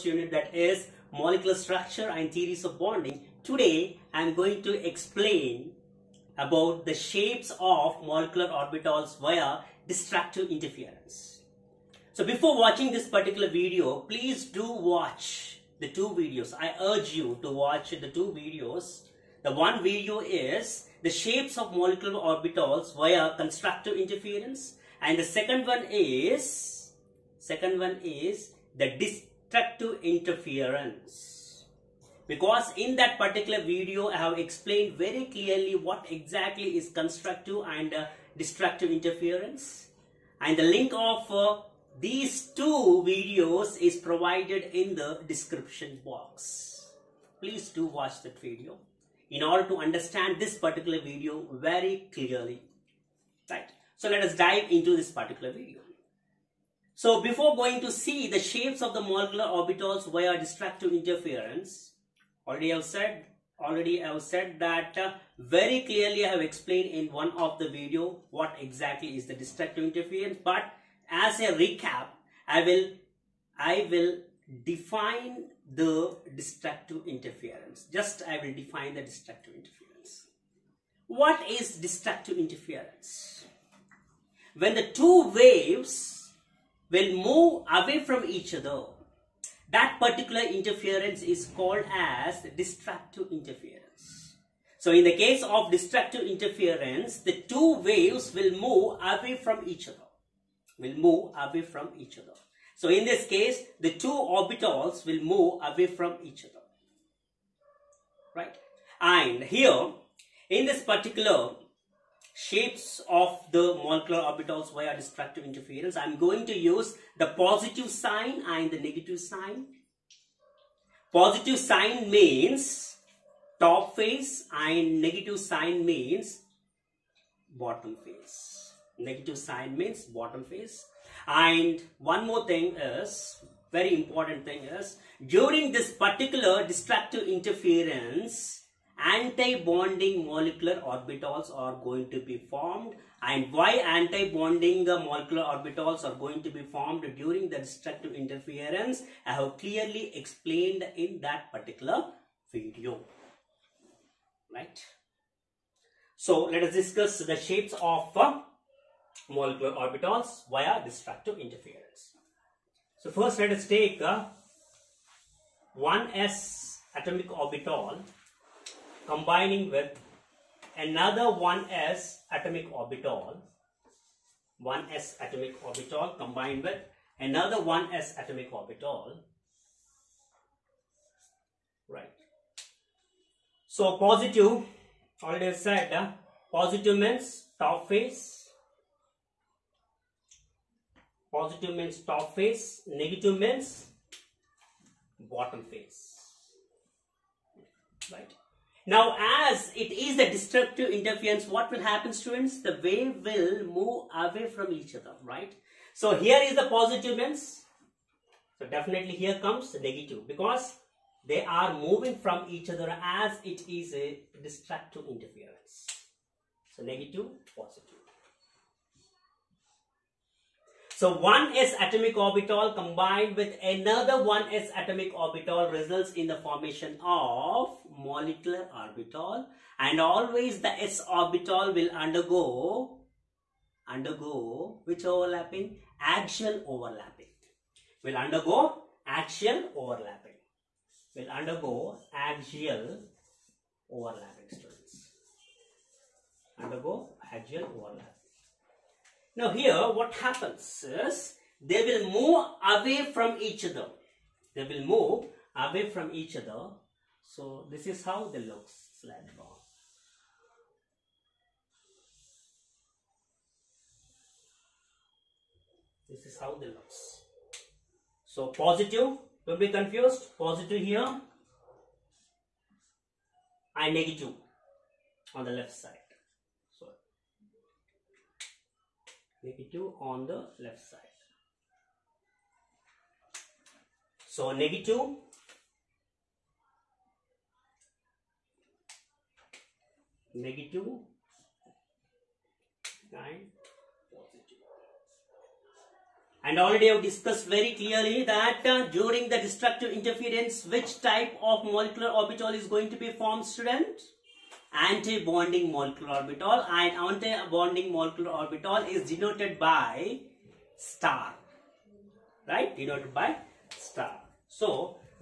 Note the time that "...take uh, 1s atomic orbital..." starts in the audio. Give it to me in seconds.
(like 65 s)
163 s.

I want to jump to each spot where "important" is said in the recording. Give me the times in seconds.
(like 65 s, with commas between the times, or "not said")
133 s.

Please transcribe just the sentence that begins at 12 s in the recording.
So before watching this particular video, please do watch the two videos.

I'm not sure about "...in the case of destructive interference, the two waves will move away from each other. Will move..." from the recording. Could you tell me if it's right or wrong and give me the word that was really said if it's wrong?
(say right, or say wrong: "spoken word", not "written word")
right.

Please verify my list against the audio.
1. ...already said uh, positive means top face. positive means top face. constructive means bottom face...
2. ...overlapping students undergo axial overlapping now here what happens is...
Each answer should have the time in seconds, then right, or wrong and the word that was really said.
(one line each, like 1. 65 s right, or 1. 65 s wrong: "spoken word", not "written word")
1. 185 s wrong: "negative", not "constructive"
2. 243 s right.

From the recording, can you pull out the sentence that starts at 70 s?
But as a recap, I will, I will define the destructive interference.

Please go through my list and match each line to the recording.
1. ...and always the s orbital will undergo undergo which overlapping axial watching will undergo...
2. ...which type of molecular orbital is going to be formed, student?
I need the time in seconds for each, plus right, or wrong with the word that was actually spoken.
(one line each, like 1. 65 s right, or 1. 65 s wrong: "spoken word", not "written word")
1. 229 s wrong: "overlapping", not "watching"
2. 300 s right.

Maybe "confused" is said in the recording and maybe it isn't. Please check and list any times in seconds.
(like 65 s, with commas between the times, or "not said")
269 s.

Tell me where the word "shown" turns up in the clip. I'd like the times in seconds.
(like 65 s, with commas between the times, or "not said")
not said.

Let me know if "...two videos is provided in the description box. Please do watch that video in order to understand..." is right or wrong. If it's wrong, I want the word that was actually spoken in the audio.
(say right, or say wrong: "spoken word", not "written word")
right.